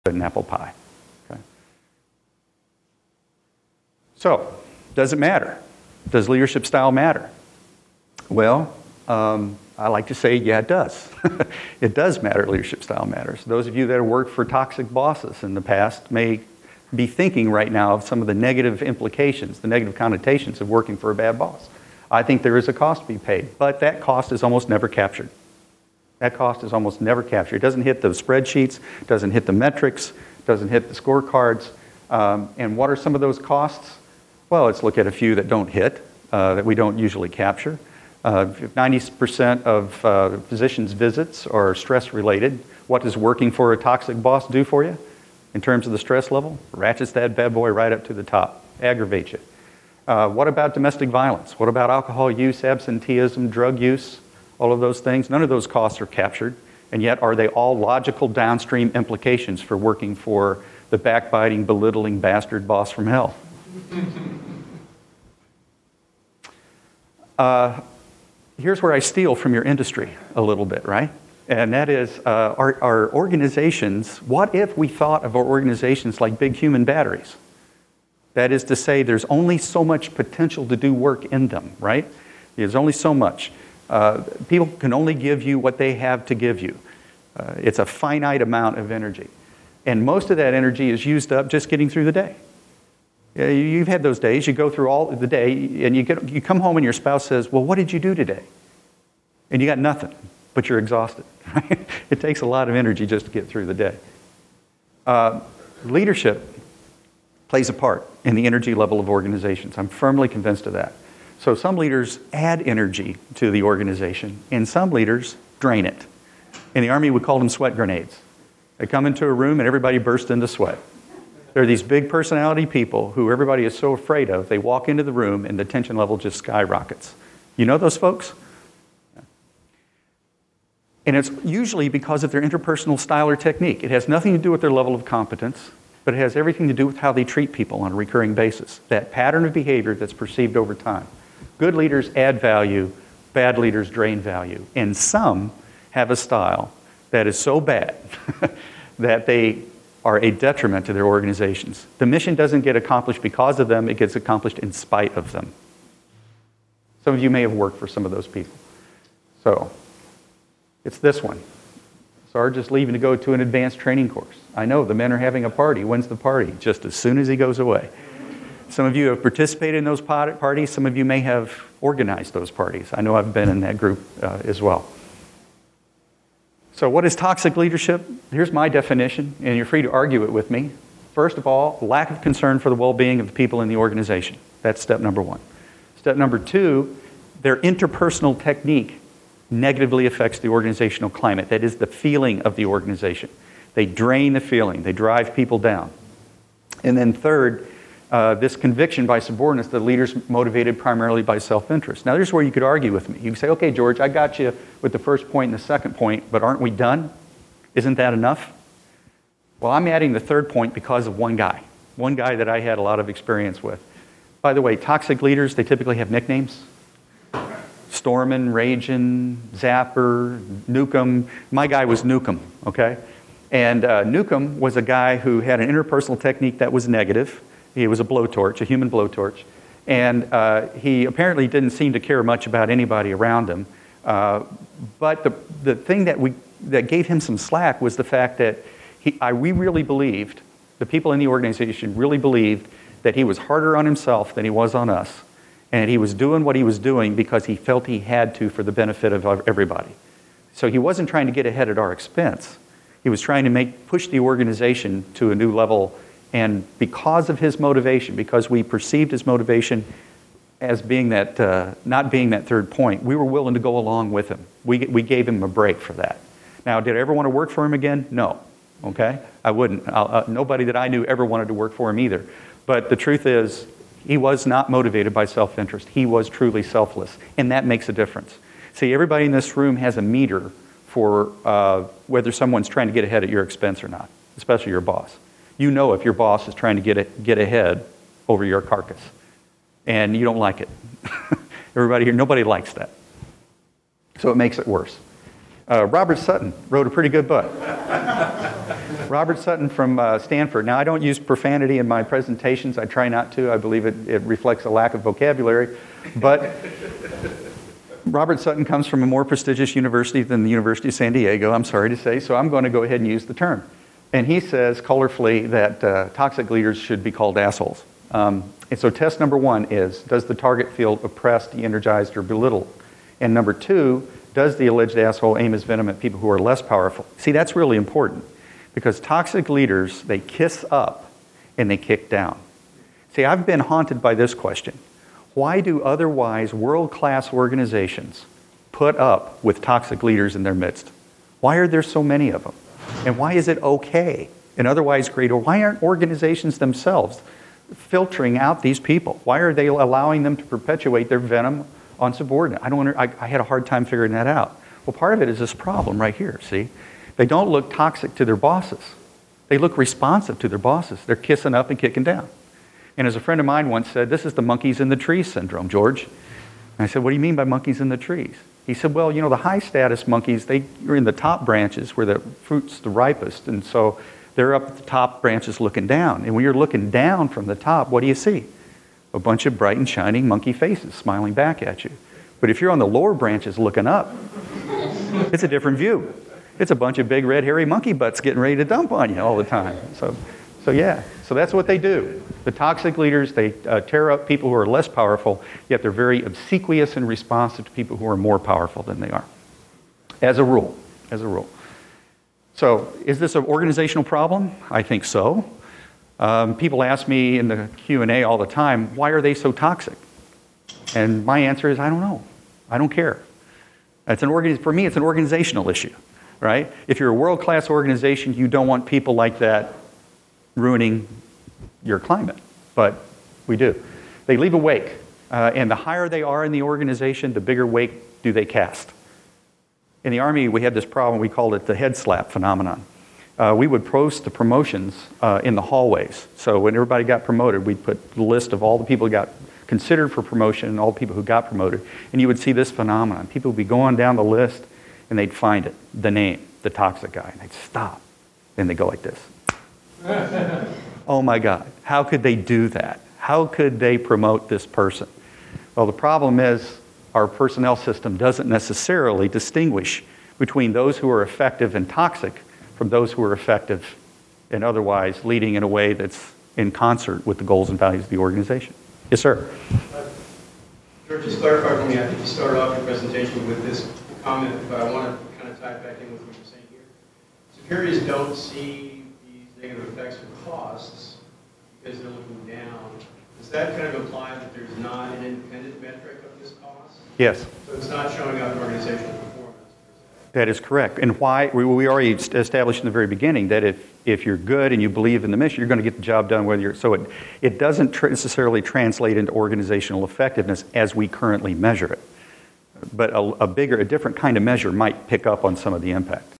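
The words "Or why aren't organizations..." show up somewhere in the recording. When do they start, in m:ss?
5:45.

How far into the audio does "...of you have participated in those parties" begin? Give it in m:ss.
2:48.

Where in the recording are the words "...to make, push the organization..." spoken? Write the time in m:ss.
4:13.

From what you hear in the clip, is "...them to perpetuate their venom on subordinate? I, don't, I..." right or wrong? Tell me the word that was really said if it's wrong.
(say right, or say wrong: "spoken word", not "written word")
right.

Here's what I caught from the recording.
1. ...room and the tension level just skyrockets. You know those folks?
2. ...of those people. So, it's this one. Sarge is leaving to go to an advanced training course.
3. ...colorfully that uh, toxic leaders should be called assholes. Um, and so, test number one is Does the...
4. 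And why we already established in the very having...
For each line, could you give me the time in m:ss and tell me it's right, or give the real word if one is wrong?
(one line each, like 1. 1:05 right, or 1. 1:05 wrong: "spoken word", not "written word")
1. 2:05 right
2. 2:38 right
3. 5:14 right
4. 8:10 wrong: "beginning", not "having".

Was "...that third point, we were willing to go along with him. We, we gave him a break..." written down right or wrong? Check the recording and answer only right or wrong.
right.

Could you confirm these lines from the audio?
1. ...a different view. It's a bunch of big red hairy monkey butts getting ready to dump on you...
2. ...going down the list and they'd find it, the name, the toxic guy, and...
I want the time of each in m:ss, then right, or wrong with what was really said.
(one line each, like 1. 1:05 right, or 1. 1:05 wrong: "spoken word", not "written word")
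1. 6:25 right
2. 7:23 right.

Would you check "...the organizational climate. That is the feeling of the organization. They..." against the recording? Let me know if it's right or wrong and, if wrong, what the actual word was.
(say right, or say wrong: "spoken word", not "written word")
right.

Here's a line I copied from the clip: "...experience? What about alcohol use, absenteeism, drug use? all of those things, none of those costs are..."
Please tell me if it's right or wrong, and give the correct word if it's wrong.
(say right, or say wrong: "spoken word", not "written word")
wrong: "violence", not "experience".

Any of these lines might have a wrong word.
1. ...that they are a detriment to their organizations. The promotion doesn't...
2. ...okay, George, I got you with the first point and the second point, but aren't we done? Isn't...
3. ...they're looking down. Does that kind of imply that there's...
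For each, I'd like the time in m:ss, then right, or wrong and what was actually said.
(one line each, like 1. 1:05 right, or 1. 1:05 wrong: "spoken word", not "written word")
1. 2:28 wrong: "mission", not "promotion"
2. 3:23 right
3. 8:01 right.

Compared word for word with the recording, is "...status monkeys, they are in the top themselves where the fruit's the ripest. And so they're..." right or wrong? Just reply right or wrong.
wrong.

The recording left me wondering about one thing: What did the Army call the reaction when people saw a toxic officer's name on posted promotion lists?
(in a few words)
head slap phenomenon.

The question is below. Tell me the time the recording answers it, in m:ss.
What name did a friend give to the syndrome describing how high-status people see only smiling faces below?
6:04.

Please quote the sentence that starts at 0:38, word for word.
90% uh, of uh, physicians' visits are stress related.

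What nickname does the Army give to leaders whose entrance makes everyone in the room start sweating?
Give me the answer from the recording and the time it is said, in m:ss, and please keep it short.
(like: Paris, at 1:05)
sweat grenades, at 1:57.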